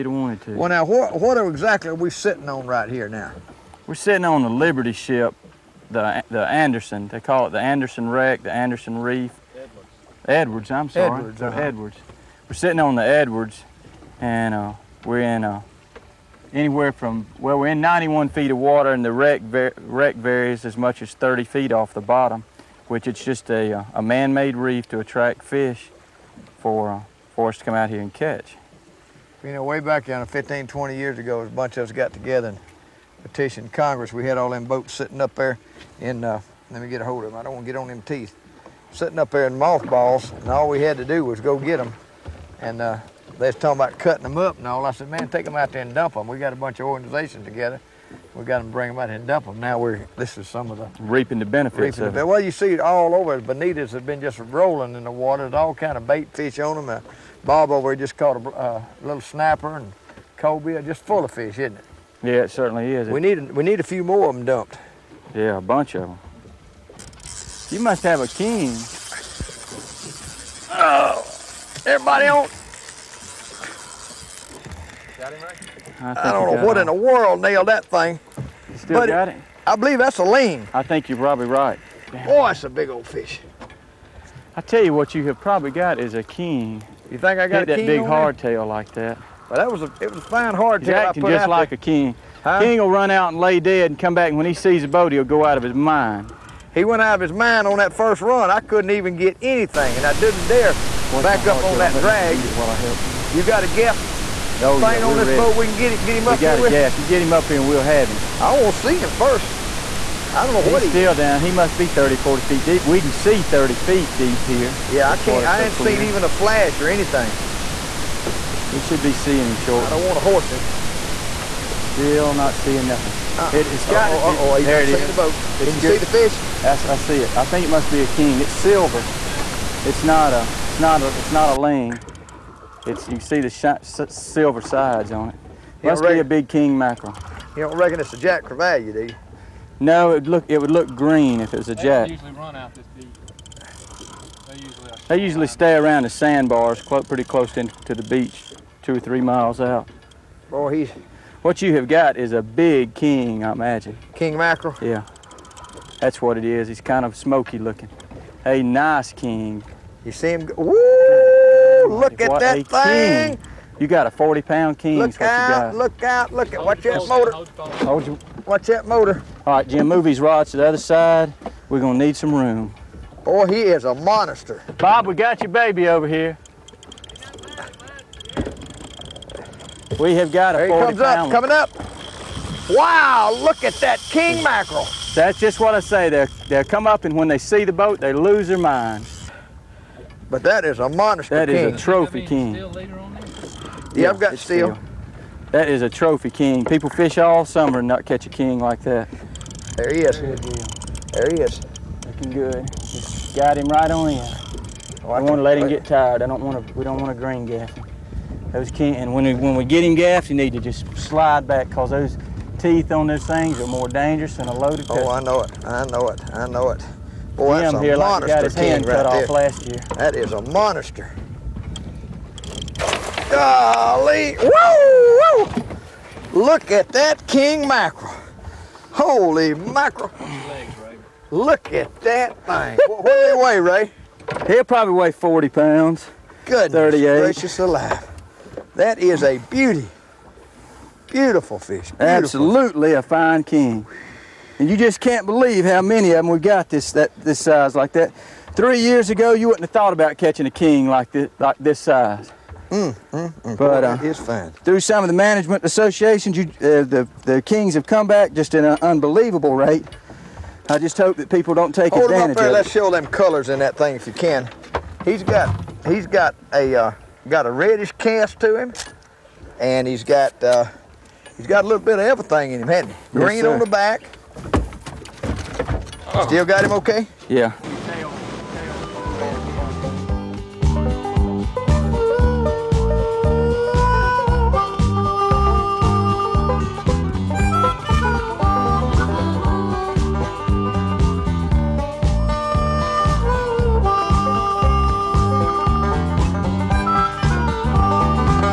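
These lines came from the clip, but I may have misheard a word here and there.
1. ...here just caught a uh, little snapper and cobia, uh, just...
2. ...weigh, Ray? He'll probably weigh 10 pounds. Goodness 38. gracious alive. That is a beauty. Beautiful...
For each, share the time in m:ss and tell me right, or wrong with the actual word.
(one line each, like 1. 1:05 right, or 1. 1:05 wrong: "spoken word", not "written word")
1. 0:57 right
2. 3:53 wrong: "40", not "10".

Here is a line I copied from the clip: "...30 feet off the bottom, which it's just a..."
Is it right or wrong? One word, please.
right.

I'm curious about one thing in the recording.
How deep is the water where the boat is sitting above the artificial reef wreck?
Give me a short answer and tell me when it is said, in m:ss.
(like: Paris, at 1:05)
91 feet, at 0:17.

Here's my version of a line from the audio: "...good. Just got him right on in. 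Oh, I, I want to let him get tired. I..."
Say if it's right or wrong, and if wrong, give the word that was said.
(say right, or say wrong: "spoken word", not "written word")
right.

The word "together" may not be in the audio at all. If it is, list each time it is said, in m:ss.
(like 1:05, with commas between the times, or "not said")
0:32, 0:47.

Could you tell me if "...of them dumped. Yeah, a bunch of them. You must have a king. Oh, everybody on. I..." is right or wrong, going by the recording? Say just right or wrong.
right.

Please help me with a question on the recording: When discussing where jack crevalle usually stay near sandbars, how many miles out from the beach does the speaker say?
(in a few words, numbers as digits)
two or three miles.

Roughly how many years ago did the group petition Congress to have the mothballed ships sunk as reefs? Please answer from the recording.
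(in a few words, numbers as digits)
15, 20 years.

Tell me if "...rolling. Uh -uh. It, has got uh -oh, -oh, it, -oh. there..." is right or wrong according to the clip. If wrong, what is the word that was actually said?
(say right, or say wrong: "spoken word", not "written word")
wrong: "nothing", not "rolling".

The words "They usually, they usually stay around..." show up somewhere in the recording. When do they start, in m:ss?
2:24.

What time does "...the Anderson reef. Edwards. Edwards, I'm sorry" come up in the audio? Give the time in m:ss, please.
0:08.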